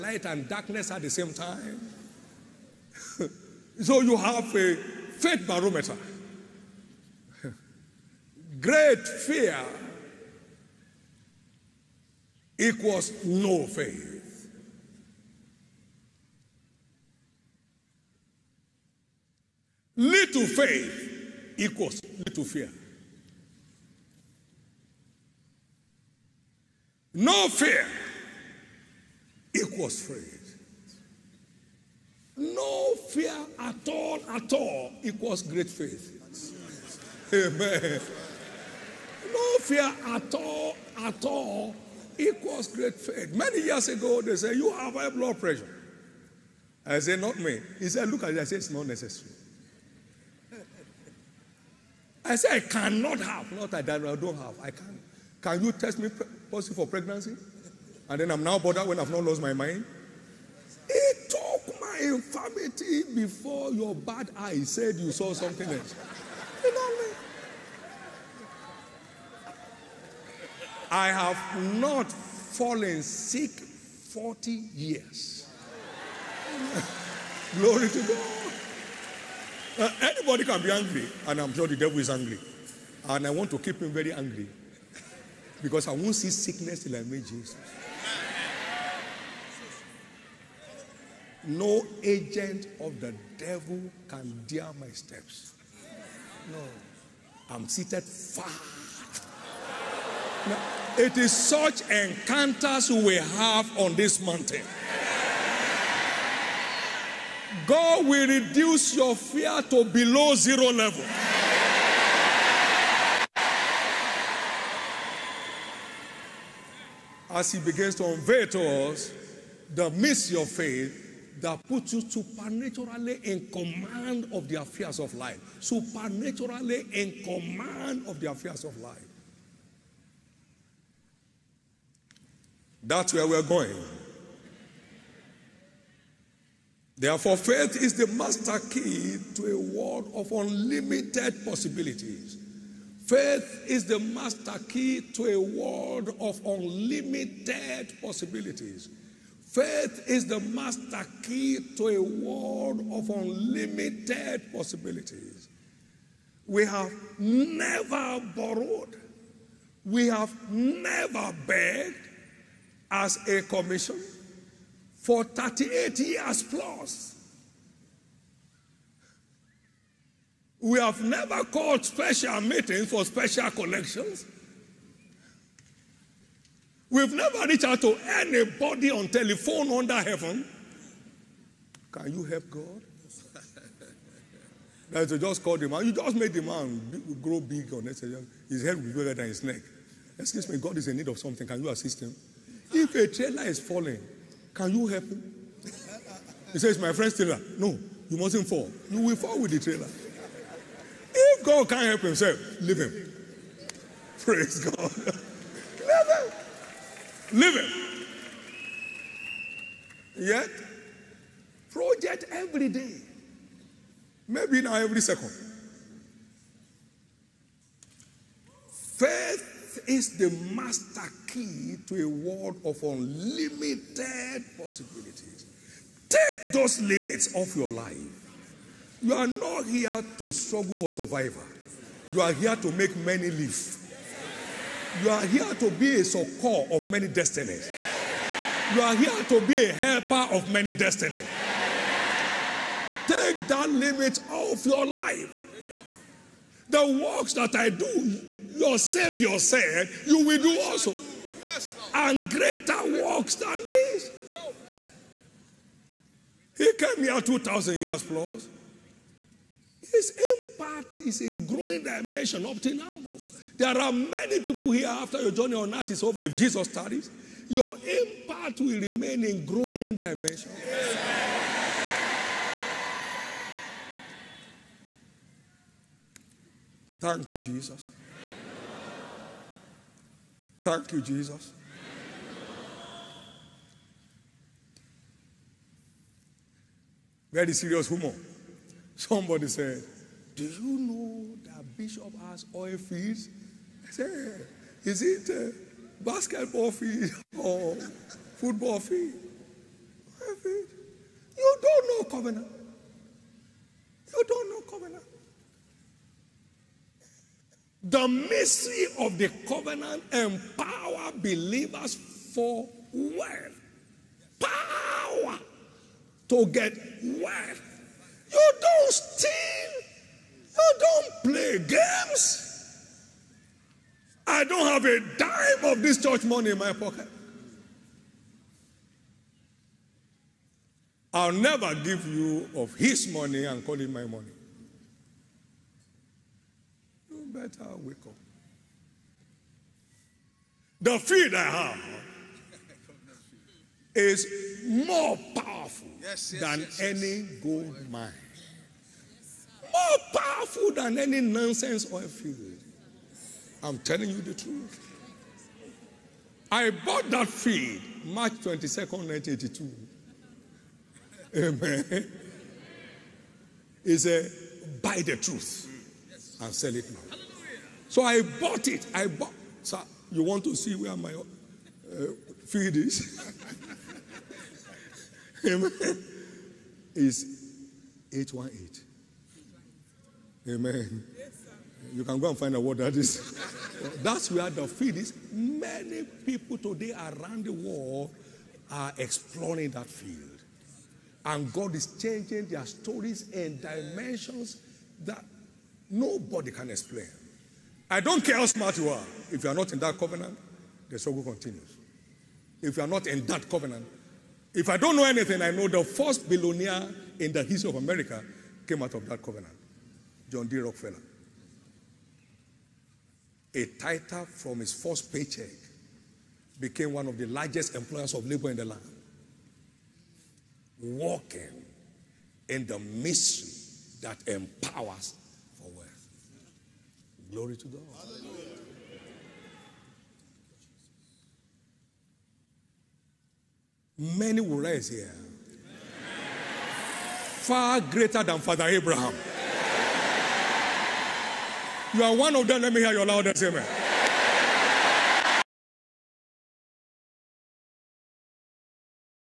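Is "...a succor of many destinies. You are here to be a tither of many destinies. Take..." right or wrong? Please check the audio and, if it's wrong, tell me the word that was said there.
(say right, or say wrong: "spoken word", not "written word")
wrong: "helper", not "tither".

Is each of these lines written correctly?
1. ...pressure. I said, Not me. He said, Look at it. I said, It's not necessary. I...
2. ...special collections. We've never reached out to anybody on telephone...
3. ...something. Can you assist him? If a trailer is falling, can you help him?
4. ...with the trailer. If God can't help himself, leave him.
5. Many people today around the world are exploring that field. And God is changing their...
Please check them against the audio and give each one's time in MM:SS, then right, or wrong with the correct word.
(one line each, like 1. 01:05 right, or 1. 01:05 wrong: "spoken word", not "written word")
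1. 00:45 right
2. 02:53 right
3. 03:11 right
4. 03:19 right
5. 06:25 right.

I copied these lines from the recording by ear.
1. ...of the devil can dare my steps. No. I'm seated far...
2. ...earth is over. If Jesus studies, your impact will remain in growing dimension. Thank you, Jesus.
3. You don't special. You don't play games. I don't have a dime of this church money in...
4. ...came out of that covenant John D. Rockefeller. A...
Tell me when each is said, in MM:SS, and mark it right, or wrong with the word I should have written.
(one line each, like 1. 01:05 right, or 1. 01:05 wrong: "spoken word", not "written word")
1. 01:32 right
2. 04:25 right
3. 05:18 wrong: "steal", not "special"
4. 06:48 right.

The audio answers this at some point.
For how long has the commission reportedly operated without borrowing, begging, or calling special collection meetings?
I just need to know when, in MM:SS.
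02:45.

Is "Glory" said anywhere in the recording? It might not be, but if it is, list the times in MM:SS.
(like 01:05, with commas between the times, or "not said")
01:17, 07:07.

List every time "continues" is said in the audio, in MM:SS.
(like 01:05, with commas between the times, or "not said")
06:41.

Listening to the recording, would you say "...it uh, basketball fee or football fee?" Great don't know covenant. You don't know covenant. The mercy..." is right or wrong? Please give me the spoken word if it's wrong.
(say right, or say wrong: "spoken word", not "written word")
wrong: "You", not "Great".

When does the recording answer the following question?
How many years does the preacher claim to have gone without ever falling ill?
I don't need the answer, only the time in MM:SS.
01:13.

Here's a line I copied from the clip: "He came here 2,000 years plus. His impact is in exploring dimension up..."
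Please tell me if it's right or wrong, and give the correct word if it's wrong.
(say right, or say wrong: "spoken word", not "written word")
wrong: "growing", not "exploring".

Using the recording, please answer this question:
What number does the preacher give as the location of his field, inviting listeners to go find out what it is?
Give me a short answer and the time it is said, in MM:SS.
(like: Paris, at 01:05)
818, at 06:18.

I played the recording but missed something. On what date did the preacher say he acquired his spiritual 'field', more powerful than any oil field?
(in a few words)
March 22nd, 1982.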